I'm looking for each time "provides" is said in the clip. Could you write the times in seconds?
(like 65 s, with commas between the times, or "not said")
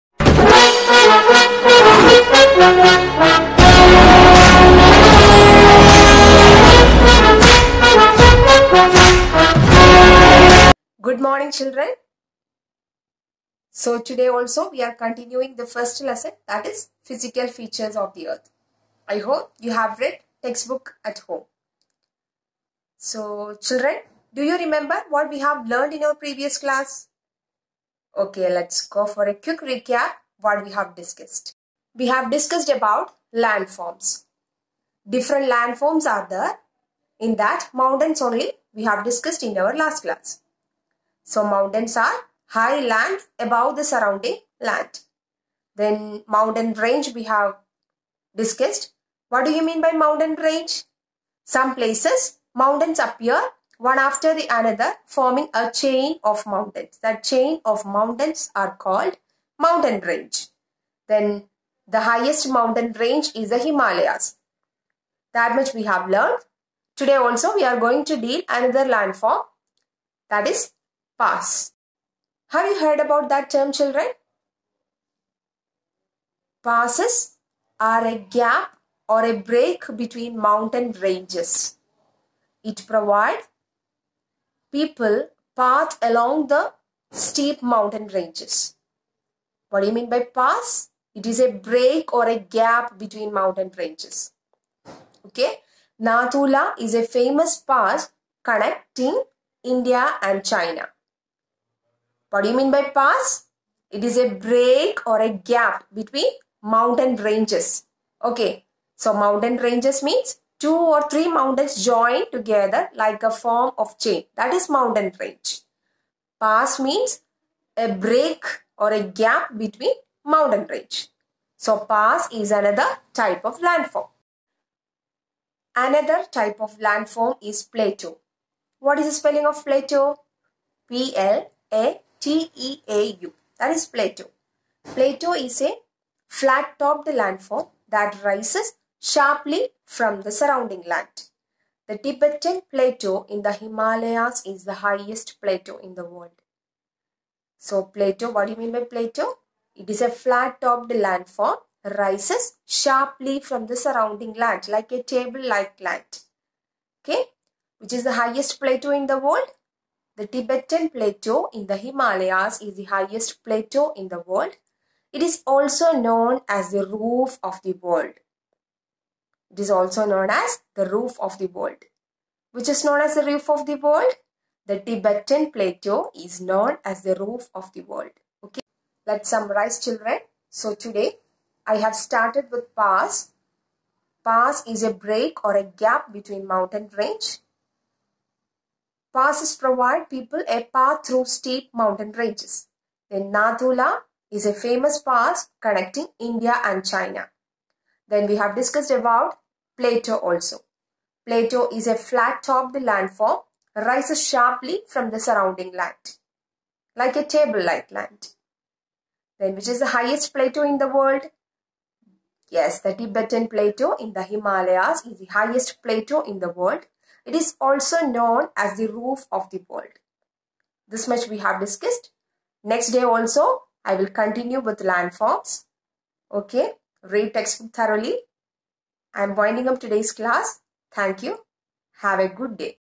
82 s, 189 s.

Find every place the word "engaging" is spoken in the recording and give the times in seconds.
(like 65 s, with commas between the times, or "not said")
not said.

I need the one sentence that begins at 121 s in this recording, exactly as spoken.
So pass is another type of landform.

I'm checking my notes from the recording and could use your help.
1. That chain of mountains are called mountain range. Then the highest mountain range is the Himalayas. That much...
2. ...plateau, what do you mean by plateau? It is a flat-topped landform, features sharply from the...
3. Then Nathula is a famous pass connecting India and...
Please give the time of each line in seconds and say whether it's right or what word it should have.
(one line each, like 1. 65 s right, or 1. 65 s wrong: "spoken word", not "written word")
1. 57 s right
2. 147 s wrong: "rises", not "features"
3. 193 s right.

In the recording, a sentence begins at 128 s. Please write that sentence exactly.
What is the spelling of plateau?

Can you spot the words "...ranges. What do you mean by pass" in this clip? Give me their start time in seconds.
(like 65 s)
88 s.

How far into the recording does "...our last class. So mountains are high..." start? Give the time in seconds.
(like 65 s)
39 s.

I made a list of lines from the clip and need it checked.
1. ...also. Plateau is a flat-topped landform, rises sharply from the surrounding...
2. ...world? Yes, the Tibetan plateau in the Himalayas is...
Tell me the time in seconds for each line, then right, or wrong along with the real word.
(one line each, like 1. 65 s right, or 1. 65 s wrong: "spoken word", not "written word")
1. 200 s right
2. 210 s right.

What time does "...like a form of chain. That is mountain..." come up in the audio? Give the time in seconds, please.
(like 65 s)
112 s.